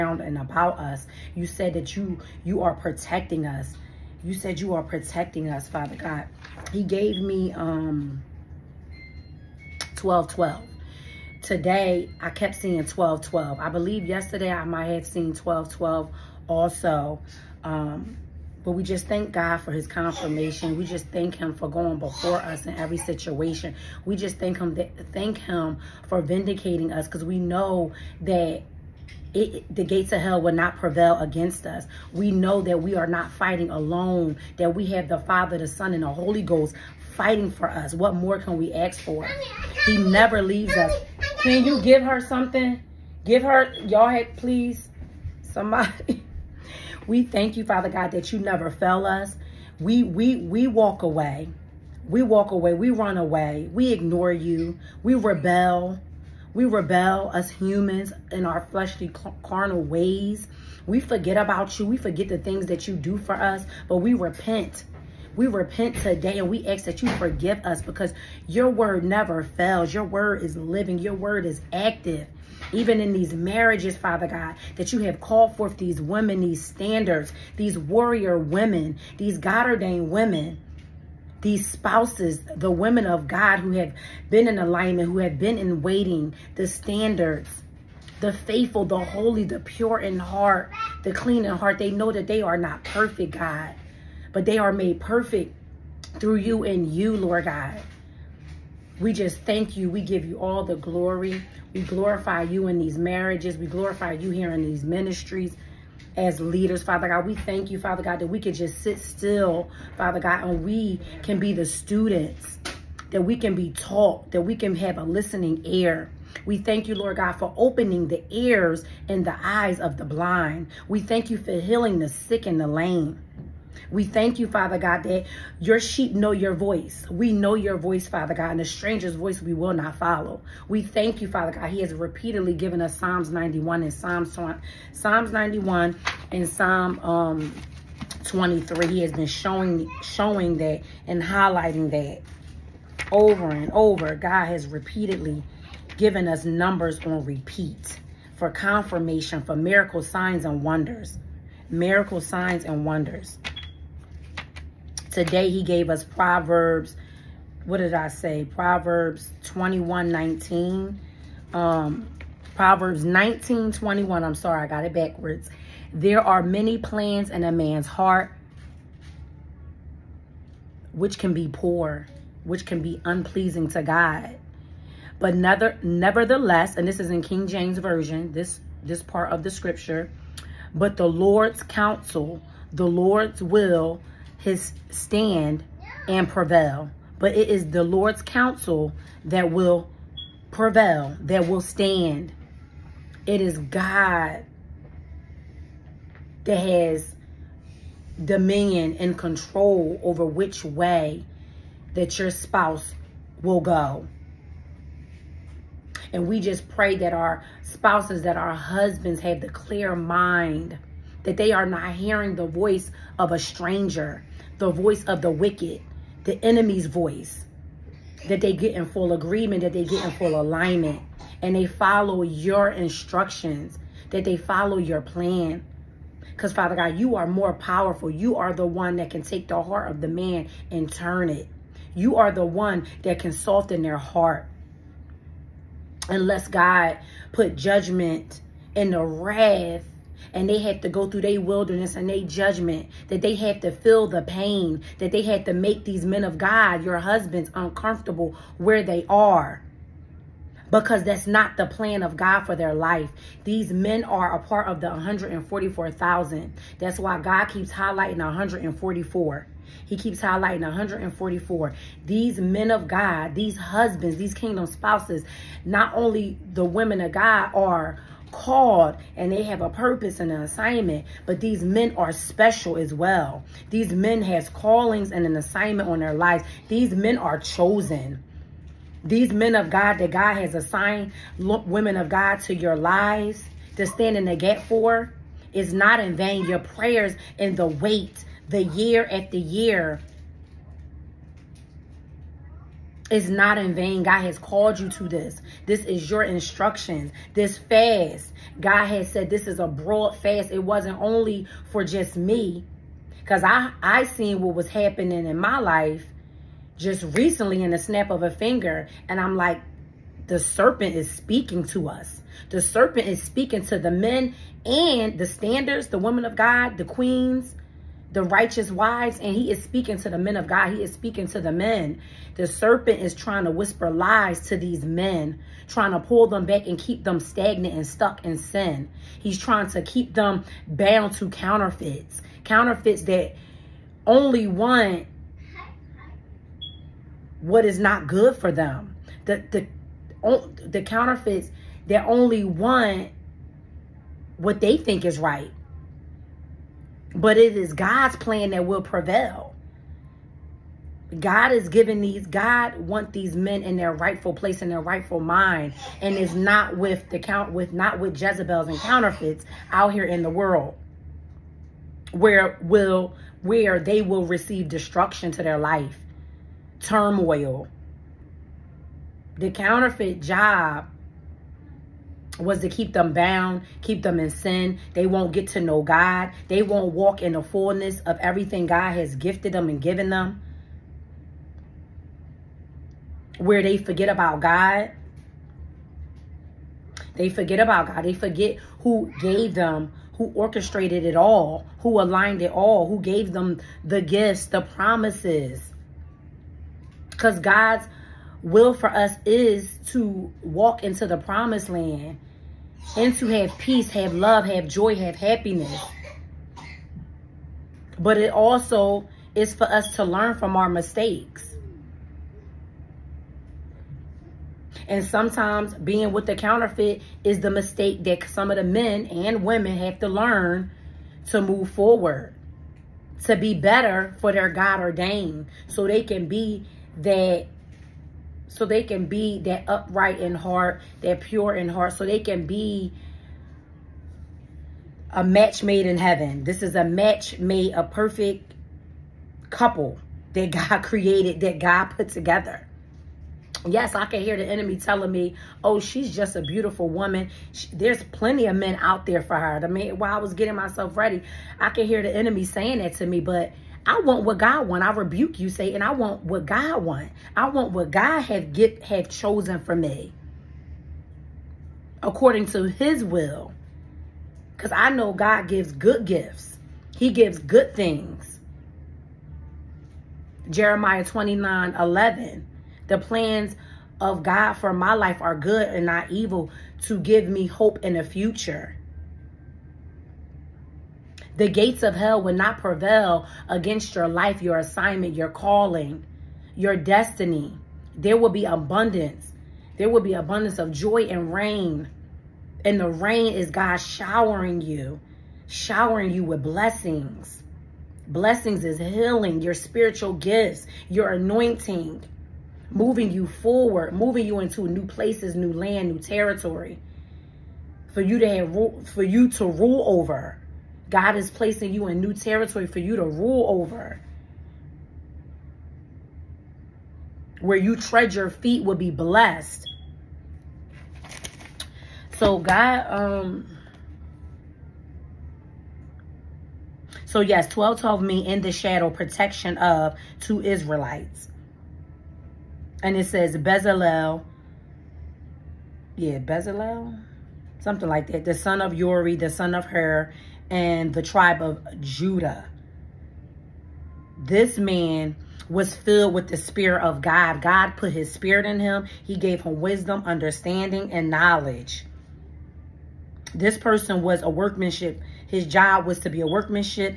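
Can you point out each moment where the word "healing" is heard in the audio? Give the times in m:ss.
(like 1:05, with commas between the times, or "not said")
2:01, 8:18.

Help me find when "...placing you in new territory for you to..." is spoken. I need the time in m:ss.
8:31.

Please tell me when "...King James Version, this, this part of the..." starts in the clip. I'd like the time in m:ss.
2:57.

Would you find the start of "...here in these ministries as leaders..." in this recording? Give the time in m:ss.
1:44.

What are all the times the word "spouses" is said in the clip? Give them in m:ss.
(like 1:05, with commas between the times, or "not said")
1:21, 3:22, 3:27, 4:24.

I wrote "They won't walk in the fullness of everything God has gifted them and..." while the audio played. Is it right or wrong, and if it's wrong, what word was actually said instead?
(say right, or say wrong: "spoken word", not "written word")
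right.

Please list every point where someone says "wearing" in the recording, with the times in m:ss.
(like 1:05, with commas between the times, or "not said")
not said.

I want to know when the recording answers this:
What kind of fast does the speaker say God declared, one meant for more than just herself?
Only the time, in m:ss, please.
4:59.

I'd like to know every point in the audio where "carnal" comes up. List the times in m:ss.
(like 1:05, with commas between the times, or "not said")
0:59.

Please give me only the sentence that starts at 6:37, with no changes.
Because God's will for us is to walk into the promised land and to have peace, have love, have joy, have happiness.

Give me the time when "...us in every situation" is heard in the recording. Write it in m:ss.
0:22.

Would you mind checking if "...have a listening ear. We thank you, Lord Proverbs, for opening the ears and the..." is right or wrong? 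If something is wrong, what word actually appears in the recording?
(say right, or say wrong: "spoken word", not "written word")
wrong: "God", not "Proverbs".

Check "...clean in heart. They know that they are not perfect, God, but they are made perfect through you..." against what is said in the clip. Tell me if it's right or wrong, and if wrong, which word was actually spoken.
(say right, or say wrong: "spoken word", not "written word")
right.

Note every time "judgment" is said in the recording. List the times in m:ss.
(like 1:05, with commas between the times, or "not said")
3:57, 4:02.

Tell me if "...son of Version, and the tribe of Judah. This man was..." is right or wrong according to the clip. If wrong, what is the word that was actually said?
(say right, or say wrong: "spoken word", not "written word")
wrong: "Hur", not "Version".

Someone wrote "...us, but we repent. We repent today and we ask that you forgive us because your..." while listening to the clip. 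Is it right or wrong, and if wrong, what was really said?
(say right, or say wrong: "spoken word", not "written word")
right.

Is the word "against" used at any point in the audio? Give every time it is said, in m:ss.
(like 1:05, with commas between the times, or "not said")
0:31, 8:03.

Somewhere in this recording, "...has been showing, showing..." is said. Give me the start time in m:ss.
2:19.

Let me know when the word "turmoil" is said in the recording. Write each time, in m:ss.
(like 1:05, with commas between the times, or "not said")
6:06.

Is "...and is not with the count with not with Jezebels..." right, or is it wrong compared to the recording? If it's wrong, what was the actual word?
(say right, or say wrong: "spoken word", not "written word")
right.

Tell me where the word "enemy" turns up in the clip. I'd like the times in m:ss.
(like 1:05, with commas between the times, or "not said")
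3:36, 7:24, 7:32.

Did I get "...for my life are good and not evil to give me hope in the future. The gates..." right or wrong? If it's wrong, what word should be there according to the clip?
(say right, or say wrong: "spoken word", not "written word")
right.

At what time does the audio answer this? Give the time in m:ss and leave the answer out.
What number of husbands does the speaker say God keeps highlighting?
4:14.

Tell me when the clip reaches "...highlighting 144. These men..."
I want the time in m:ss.
4:20.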